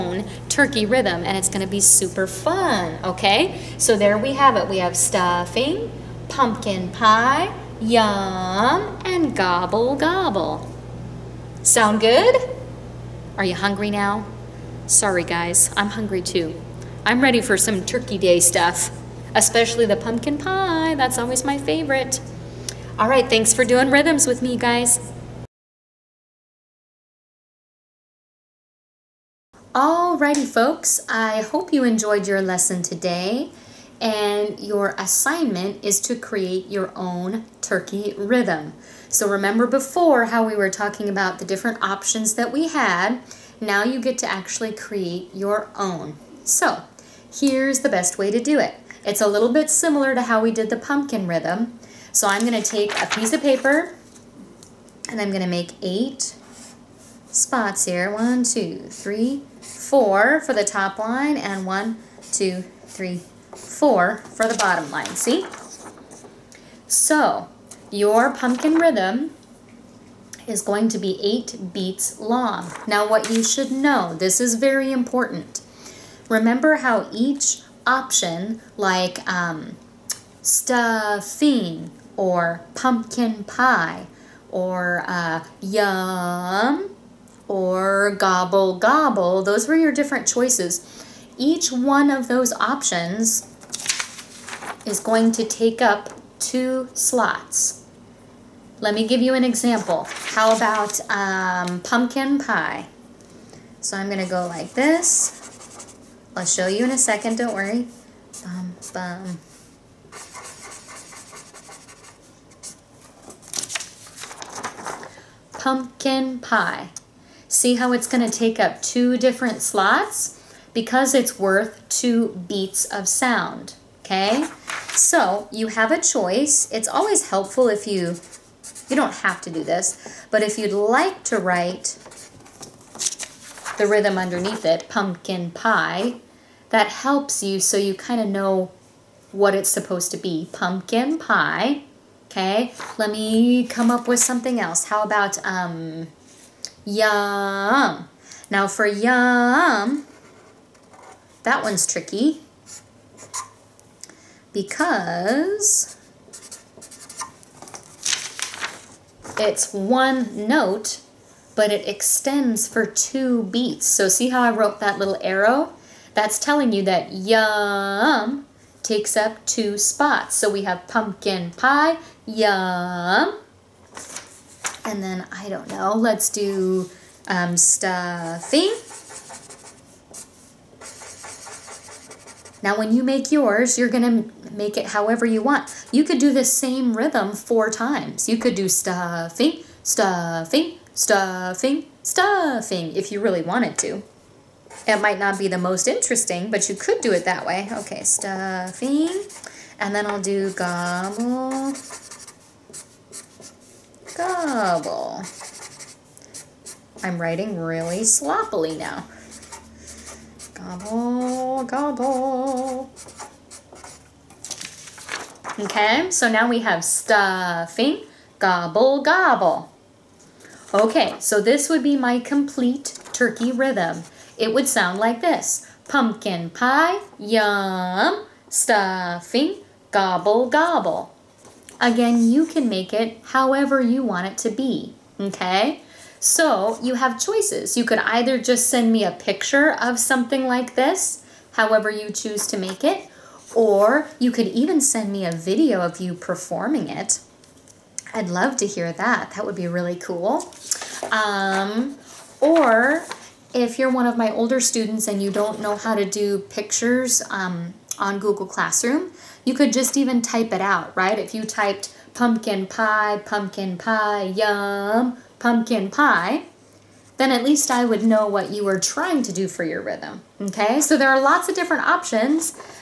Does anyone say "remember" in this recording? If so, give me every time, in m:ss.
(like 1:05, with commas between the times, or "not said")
0:39, 1:16.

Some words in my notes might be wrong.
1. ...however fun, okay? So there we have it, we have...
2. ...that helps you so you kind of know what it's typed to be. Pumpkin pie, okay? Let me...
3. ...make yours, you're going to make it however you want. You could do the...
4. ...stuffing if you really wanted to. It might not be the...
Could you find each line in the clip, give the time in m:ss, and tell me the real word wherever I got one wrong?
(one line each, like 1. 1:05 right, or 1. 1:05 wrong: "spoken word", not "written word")
1. 0:01 wrong: "super", not "however"
2. 2:16 wrong: "supposed", not "typed"
3. 3:03 right
4. 3:12 right.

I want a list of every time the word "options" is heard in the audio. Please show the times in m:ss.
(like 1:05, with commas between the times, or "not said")
0:41, 1:17, 1:32, 4:31.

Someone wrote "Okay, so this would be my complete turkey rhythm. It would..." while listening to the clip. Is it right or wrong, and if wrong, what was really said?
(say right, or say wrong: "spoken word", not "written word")
right.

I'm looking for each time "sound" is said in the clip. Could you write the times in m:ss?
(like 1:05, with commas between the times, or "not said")
0:11, 2:03, 3:44.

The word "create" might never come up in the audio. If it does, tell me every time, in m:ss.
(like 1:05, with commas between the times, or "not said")
0:36, 0:44.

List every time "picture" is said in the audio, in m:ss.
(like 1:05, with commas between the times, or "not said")
3:59, 4:16.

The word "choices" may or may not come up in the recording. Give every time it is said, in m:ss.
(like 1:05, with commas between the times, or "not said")
1:30, 2:05, 3:57.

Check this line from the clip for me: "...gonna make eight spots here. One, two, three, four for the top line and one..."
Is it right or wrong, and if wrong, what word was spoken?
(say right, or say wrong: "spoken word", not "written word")
right.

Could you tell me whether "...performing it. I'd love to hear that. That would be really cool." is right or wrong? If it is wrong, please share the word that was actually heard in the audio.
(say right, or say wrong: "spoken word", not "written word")
right.